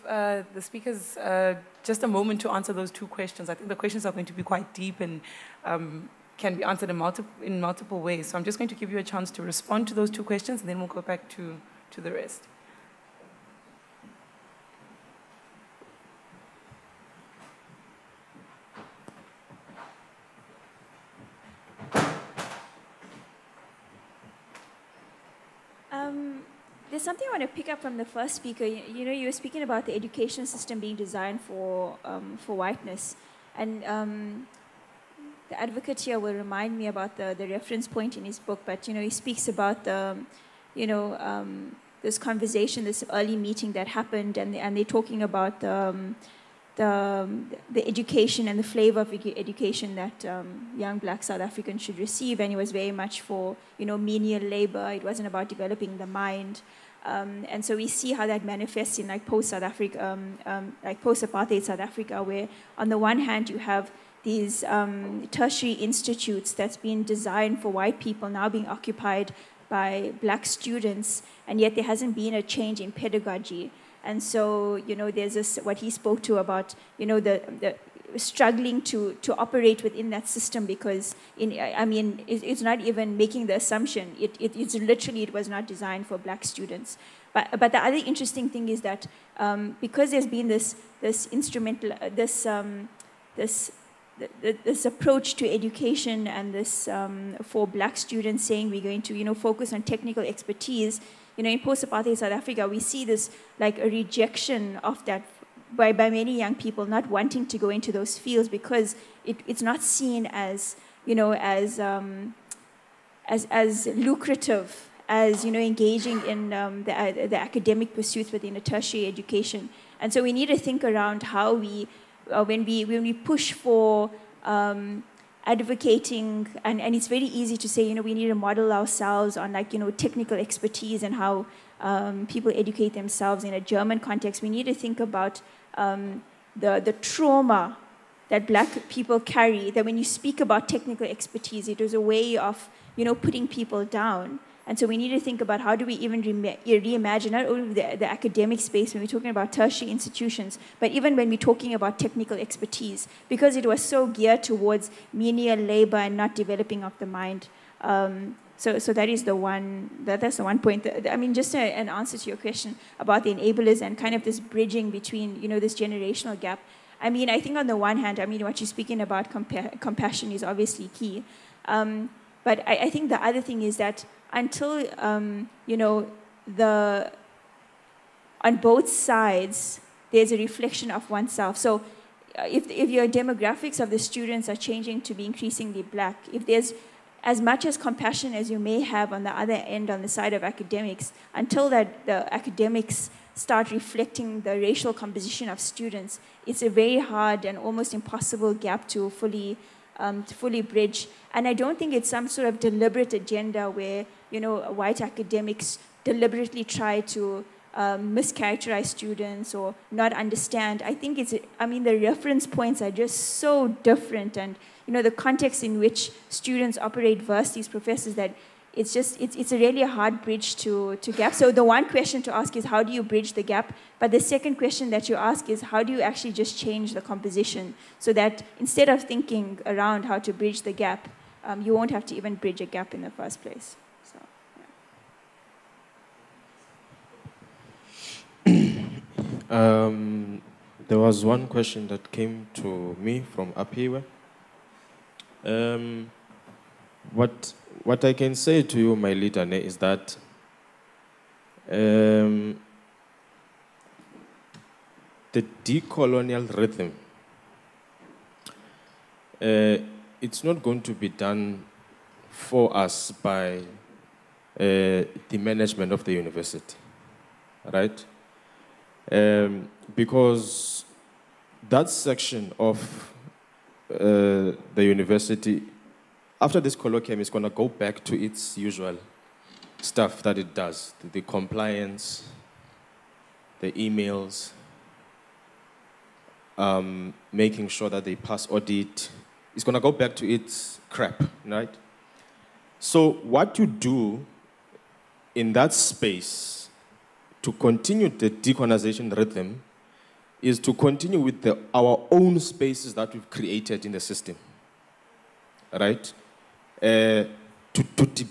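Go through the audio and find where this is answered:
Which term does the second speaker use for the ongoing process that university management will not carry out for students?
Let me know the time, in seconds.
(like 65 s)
255 s.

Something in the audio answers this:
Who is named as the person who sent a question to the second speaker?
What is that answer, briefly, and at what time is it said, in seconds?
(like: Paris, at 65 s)
Apiwe, at 243 s.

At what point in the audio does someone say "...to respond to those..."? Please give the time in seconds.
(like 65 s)
9 s.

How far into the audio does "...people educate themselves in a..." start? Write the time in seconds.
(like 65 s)
132 s.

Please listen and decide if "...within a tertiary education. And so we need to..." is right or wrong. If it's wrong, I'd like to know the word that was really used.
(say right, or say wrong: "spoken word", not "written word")
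right.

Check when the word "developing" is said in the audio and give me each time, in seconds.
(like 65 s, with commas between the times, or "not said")
55 s, 156 s.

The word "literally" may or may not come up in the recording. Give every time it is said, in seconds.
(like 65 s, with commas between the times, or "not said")
84 s.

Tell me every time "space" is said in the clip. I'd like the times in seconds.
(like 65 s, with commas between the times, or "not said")
148 s, 295 s, 302 s.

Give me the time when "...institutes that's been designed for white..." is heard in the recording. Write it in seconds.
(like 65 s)
65 s.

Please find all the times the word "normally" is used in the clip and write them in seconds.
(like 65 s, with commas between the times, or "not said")
not said.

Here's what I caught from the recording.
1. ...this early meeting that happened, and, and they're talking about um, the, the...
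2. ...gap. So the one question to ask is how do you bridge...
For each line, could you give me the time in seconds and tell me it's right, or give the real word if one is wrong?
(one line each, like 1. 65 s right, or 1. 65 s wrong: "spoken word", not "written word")
1. 42 s right
2. 221 s right.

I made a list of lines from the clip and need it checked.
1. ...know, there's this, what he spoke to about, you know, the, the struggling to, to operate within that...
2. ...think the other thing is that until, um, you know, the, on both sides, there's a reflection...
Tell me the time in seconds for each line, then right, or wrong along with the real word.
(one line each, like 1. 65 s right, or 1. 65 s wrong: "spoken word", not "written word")
1. 74 s right
2. 172 s right.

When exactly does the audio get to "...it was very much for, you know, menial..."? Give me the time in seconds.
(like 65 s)
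52 s.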